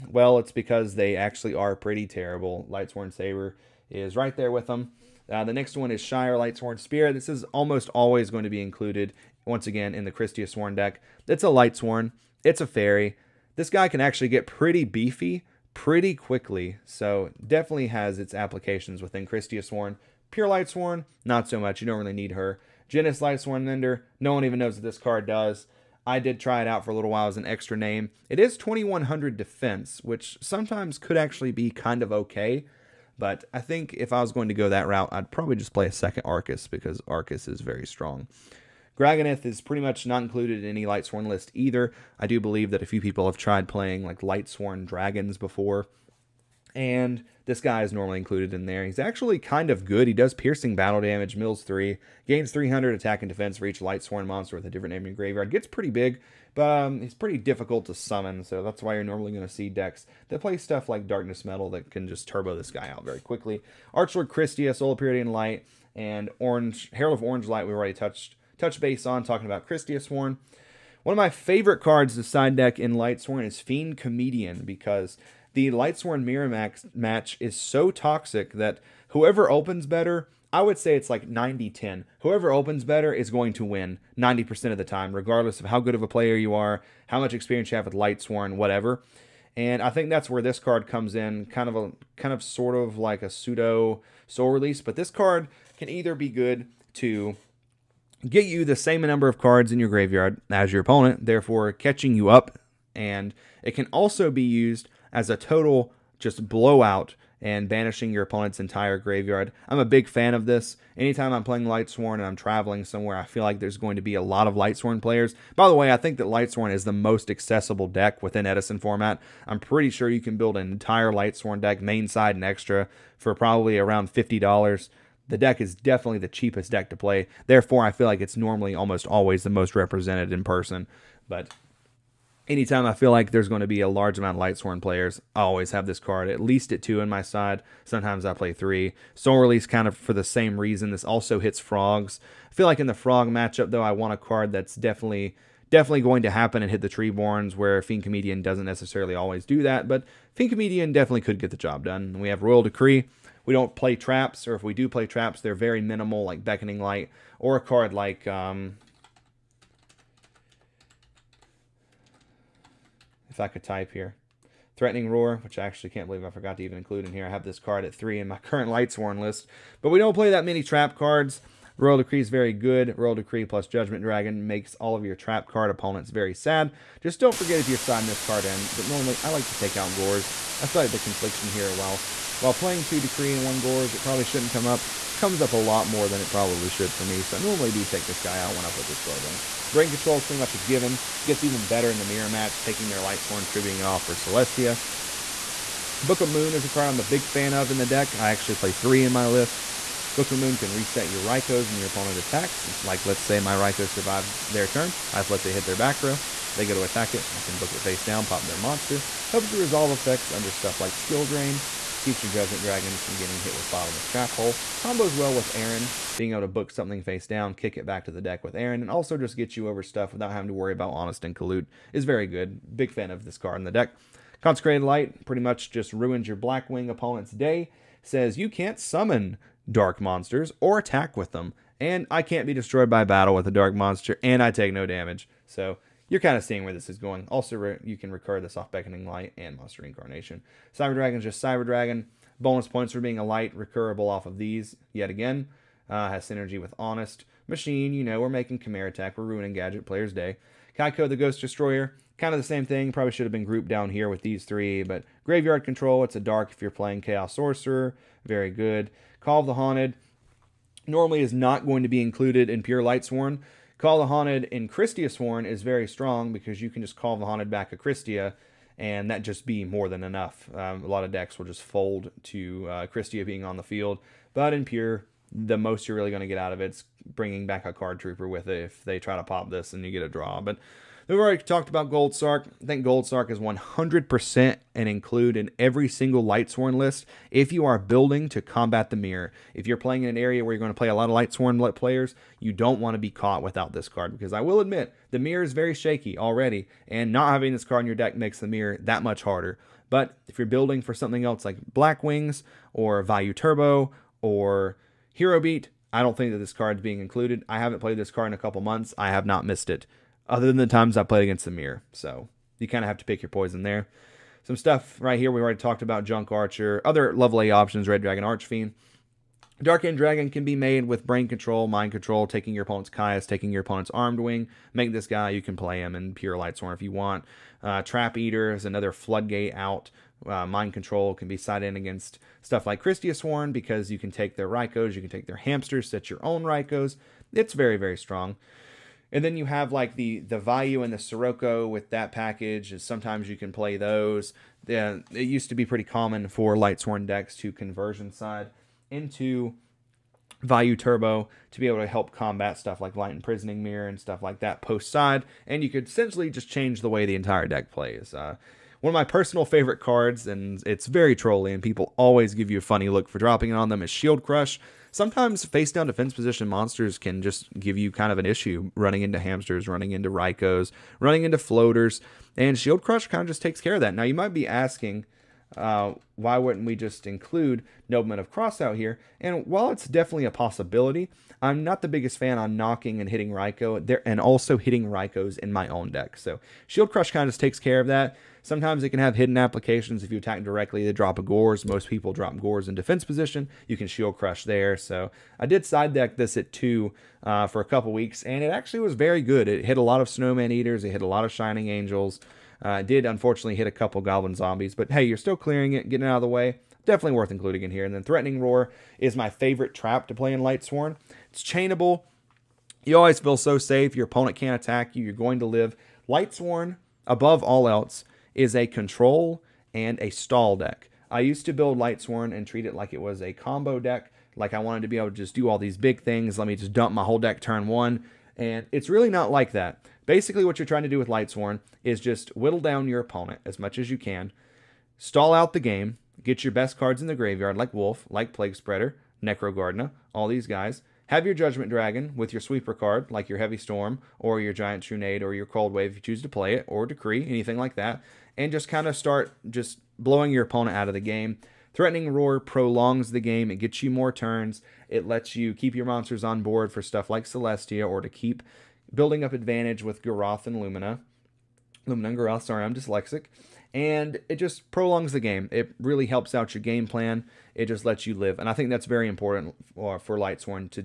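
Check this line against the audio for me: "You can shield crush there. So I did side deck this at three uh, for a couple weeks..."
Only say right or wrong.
wrong.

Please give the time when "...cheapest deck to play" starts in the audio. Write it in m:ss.
2:06.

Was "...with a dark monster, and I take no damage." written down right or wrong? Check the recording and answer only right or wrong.
right.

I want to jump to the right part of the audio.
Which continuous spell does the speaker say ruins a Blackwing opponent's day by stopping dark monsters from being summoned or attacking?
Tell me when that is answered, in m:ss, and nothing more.
3:44.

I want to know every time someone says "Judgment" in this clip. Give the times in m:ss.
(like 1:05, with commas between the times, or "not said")
2:53, 3:32, 7:21.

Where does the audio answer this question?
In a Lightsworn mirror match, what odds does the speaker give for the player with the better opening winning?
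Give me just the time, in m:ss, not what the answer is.
1:21.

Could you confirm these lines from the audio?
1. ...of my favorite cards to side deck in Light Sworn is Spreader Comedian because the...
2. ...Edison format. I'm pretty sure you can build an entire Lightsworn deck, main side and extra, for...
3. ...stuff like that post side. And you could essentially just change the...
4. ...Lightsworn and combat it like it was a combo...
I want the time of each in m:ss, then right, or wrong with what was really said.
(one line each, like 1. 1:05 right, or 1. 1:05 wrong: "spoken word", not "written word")
1. 1:11 wrong: "Fiend", not "Spreader"
2. 1:58 right
3. 5:54 right
4. 7:01 wrong: "treat", not "combat".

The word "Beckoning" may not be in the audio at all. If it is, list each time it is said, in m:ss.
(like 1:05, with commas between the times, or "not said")
2:36, 3:58.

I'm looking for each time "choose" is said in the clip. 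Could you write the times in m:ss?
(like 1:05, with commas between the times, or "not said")
7:26.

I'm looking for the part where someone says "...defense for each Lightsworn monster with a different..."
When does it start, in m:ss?
0:53.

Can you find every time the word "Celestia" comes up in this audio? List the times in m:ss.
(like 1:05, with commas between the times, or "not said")
3:14, 7:37.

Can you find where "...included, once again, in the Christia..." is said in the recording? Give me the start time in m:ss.
0:08.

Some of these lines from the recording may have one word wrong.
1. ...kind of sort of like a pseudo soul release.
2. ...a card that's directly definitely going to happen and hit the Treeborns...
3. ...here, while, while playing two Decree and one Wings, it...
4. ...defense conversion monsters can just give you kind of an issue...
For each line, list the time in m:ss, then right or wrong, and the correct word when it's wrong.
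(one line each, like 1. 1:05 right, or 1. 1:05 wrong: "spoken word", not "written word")
1. 1:32 right
2. 2:24 wrong: "definitely", not "directly"
3. 3:01 wrong: "Gorz", not "Wings"
4. 6:05 wrong: "position", not "conversion".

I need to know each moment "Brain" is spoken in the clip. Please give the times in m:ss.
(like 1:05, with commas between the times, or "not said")
3:09, 5:21.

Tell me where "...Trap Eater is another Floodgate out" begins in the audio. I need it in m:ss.
5:27.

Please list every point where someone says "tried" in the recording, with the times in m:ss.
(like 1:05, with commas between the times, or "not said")
0:43.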